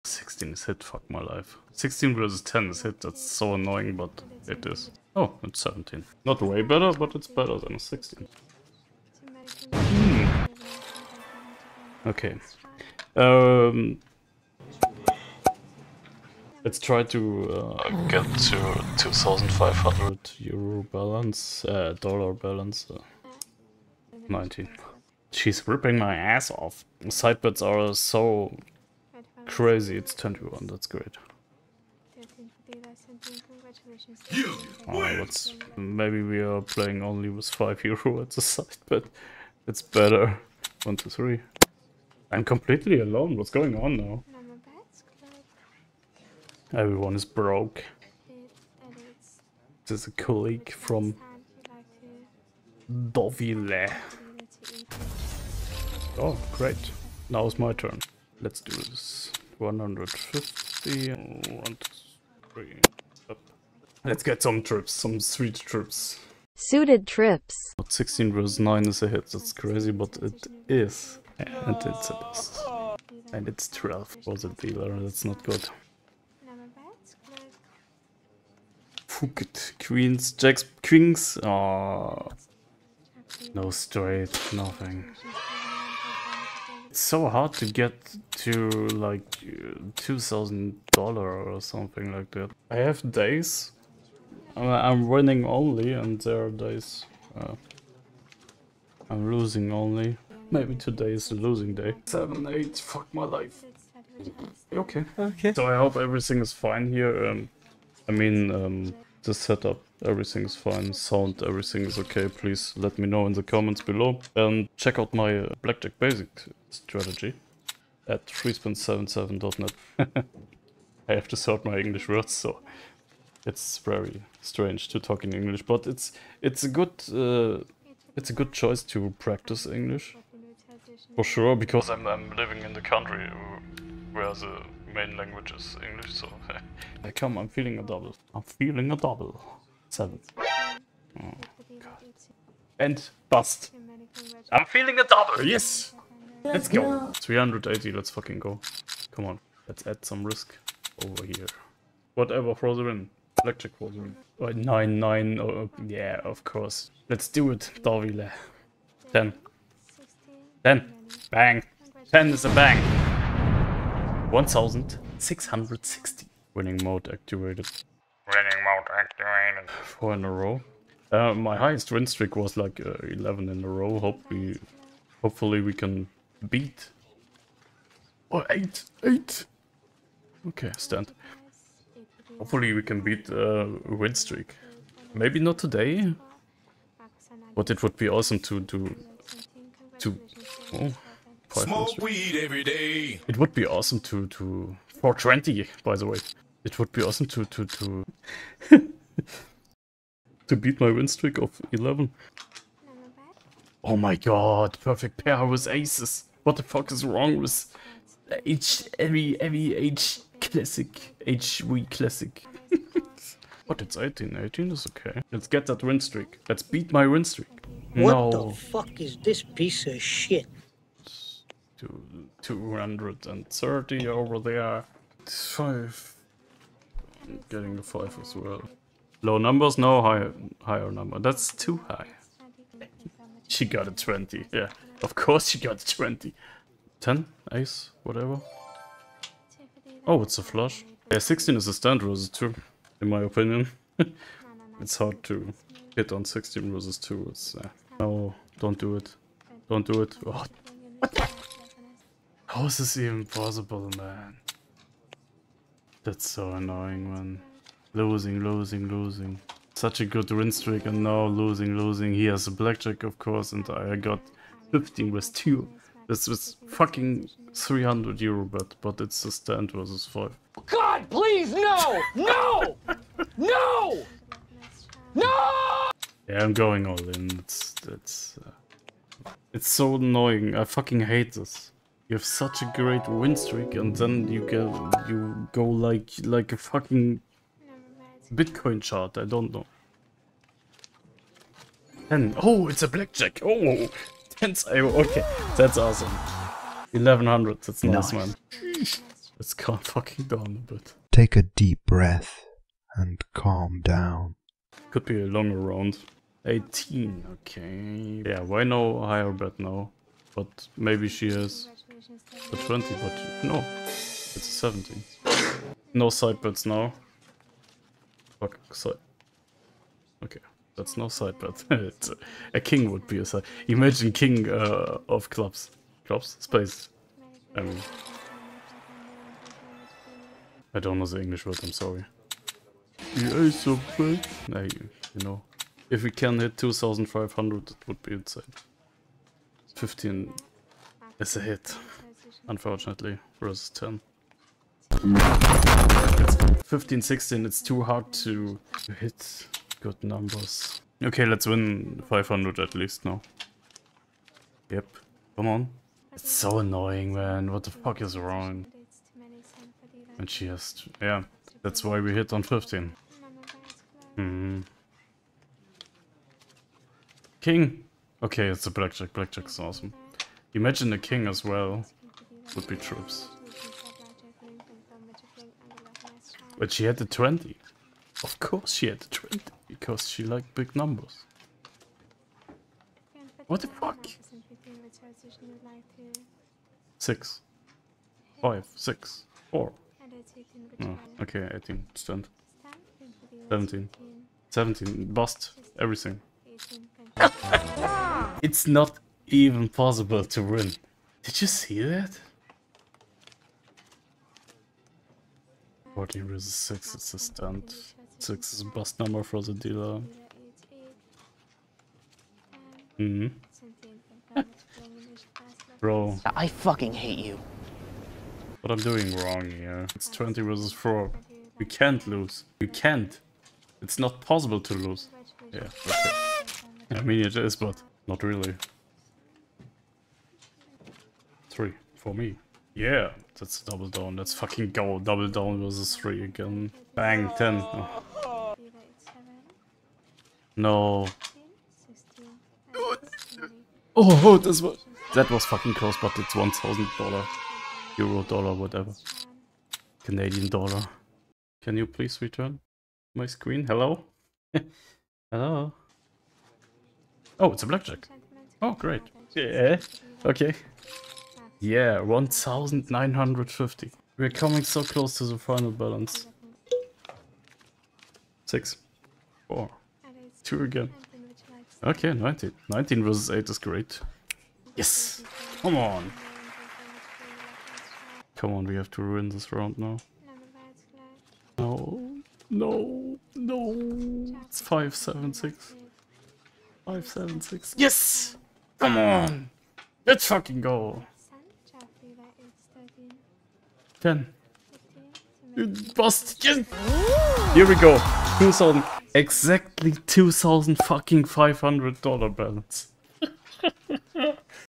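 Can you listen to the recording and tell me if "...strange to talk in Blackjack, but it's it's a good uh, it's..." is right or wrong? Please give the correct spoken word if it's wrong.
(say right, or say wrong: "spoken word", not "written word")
wrong: "English", not "Blackjack".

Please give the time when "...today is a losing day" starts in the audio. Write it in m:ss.
1:40.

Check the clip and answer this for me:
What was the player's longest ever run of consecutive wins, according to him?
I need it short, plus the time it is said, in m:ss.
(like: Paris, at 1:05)
11, at 2:53.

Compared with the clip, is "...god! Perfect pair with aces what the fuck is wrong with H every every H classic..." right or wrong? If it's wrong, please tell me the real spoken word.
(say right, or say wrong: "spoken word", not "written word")
right.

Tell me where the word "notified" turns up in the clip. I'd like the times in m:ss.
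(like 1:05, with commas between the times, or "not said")
not said.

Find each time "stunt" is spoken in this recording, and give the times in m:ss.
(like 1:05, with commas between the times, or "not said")
6:47.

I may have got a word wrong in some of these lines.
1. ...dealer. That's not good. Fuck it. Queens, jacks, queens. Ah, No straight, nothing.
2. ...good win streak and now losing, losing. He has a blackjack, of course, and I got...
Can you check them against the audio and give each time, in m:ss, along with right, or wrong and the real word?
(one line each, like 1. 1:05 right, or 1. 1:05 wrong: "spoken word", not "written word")
1. 1:14 right
2. 4:20 right.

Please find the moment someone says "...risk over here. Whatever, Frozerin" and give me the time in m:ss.
2:30.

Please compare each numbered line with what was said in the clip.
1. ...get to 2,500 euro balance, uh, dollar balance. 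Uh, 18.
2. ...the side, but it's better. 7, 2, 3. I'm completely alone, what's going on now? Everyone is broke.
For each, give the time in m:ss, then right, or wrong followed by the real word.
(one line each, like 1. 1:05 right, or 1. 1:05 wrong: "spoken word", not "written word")
1. 0:18 wrong: "19", not "18"
2. 0:38 wrong: "1", not "7".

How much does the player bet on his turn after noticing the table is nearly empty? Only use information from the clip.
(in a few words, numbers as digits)
150.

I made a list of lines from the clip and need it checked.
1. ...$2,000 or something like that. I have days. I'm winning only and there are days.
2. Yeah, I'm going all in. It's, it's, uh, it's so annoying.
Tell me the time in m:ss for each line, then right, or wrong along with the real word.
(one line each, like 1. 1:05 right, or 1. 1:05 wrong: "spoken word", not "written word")
1. 1:29 right
2. 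4:36 right.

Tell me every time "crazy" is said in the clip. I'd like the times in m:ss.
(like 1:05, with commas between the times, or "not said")
0:29, 1:09.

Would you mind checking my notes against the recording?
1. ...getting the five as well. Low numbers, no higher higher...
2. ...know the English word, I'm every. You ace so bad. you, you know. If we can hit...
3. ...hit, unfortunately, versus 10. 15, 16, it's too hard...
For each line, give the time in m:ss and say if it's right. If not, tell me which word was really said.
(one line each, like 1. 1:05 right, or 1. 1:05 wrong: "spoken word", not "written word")
1. 3:47 right
2. 5:30 wrong: "sorry", not "every"
3. 5:41 right.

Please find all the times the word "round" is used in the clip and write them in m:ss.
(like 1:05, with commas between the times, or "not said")
5:05, 7:59.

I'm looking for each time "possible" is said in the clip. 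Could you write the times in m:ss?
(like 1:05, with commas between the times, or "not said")
4:13, 6:39, 7:04.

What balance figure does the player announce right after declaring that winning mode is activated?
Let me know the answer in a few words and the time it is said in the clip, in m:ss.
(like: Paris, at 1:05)
1660, at 2:44.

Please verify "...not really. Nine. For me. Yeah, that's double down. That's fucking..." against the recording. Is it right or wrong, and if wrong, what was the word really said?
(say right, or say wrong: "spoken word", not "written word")
wrong: "Three", not "Nine".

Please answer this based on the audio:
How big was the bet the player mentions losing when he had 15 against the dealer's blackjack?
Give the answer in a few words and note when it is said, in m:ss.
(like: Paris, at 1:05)
300 euro, at 4:27.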